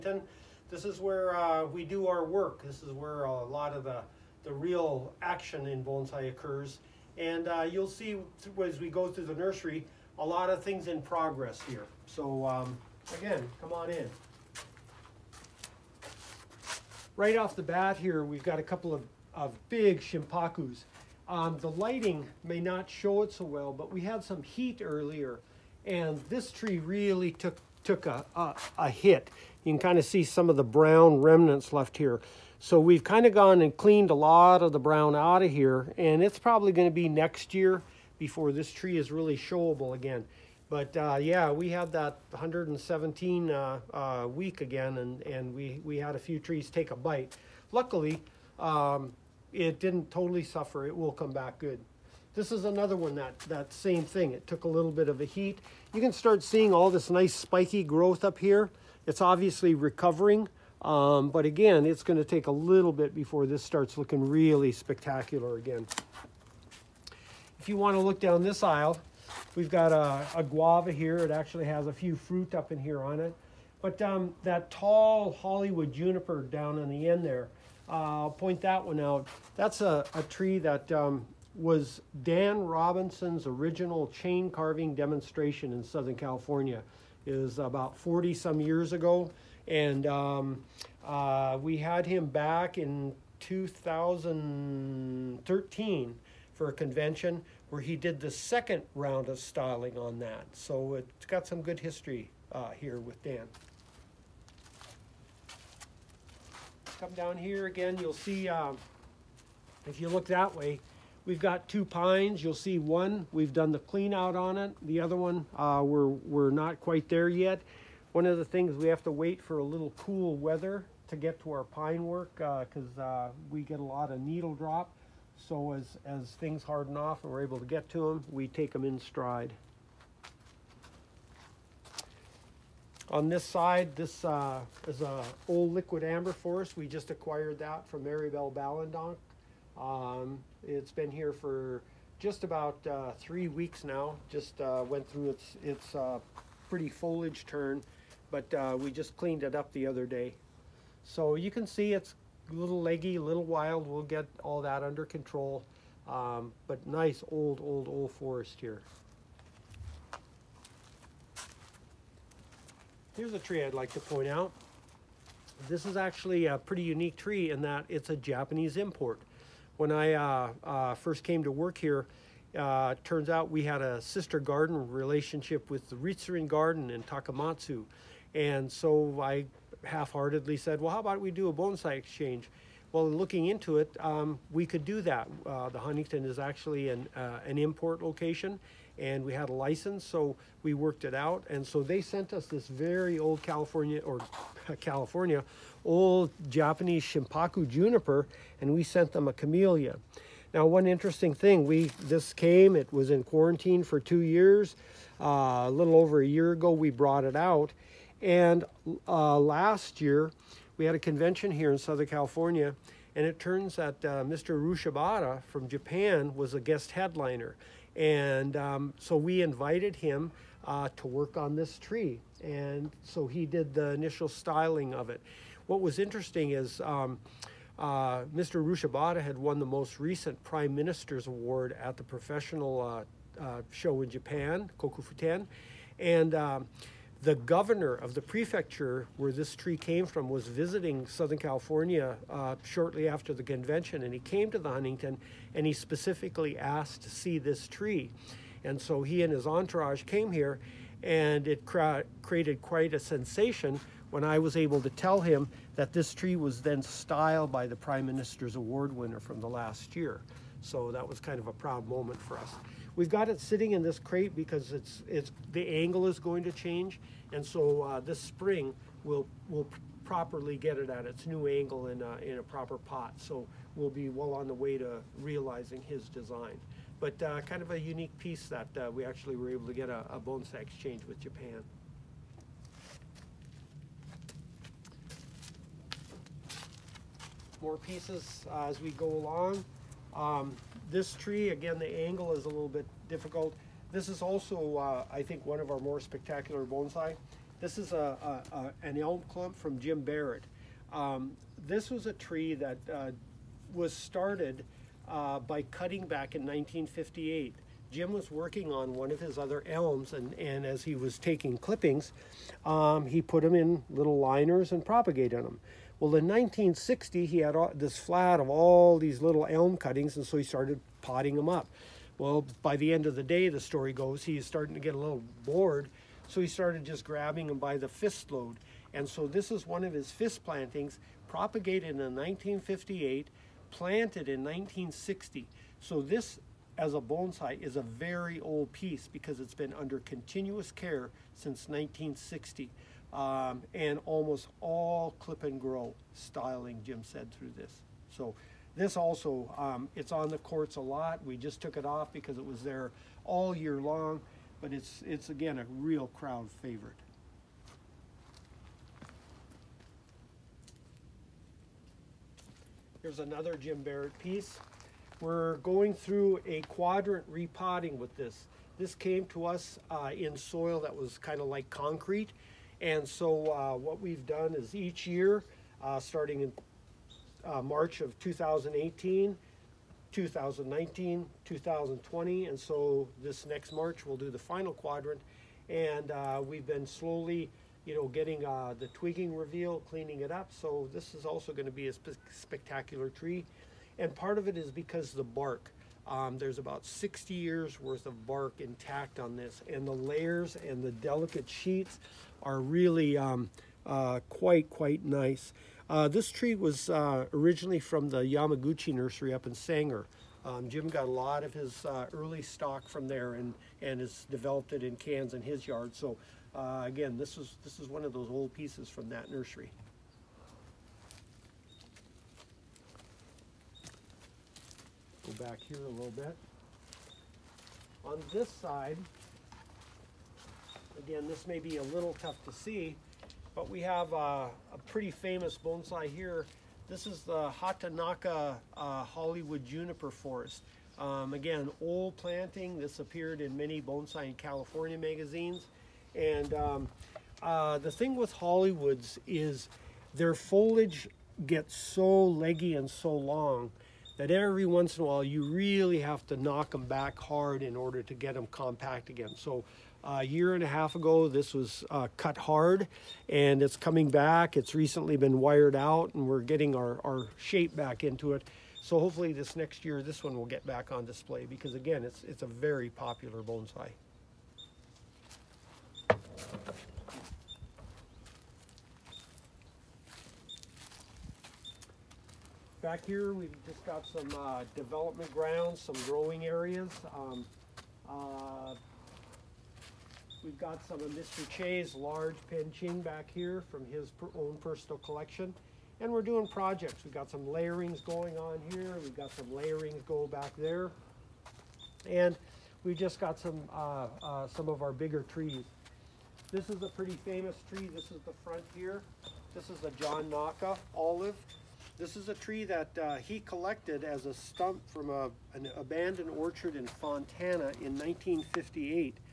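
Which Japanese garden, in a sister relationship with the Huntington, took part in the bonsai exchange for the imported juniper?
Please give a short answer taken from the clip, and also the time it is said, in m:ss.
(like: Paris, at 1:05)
Ritsurin Garden, at 2:55.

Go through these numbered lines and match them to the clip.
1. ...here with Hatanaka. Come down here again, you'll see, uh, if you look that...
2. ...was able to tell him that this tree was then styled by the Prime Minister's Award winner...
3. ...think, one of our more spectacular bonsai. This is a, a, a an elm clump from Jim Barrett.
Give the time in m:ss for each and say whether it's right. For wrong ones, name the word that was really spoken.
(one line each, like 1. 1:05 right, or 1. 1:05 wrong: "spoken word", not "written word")
1. 1:42 wrong: "Dan", not "Hatanaka"
2. 4:14 right
3. 4:55 right.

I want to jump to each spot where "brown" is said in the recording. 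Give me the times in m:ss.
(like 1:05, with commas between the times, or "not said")
0:30, 0:34.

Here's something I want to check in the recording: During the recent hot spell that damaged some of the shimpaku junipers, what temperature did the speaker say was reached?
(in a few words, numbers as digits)
117.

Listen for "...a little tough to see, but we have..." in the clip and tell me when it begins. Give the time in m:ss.
7:11.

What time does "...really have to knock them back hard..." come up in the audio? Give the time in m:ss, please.
7:35.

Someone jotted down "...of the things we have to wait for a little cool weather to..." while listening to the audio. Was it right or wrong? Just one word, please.
right.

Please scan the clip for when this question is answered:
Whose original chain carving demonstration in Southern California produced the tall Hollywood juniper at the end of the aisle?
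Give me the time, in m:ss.
1:22.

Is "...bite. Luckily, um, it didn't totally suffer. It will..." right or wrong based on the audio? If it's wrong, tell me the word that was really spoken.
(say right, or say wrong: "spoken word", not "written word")
right.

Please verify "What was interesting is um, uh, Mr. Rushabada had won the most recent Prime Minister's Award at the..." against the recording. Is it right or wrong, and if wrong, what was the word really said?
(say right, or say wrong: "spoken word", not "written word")
right.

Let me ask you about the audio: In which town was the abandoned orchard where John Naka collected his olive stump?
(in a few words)
Fontana.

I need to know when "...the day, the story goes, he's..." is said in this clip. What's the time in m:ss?
5:23.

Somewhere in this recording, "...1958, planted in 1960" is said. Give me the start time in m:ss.
5:31.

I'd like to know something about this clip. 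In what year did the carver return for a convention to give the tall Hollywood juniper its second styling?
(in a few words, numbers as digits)
2013.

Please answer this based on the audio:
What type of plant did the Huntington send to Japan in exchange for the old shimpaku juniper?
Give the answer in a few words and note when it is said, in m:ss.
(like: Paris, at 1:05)
Camellia, at 3:19.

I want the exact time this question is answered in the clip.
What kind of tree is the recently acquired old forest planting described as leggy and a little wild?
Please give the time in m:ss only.
2:15.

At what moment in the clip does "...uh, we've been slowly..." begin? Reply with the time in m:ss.
6:26.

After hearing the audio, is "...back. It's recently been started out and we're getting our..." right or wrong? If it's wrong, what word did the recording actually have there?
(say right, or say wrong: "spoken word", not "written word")
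wrong: "wired", not "started".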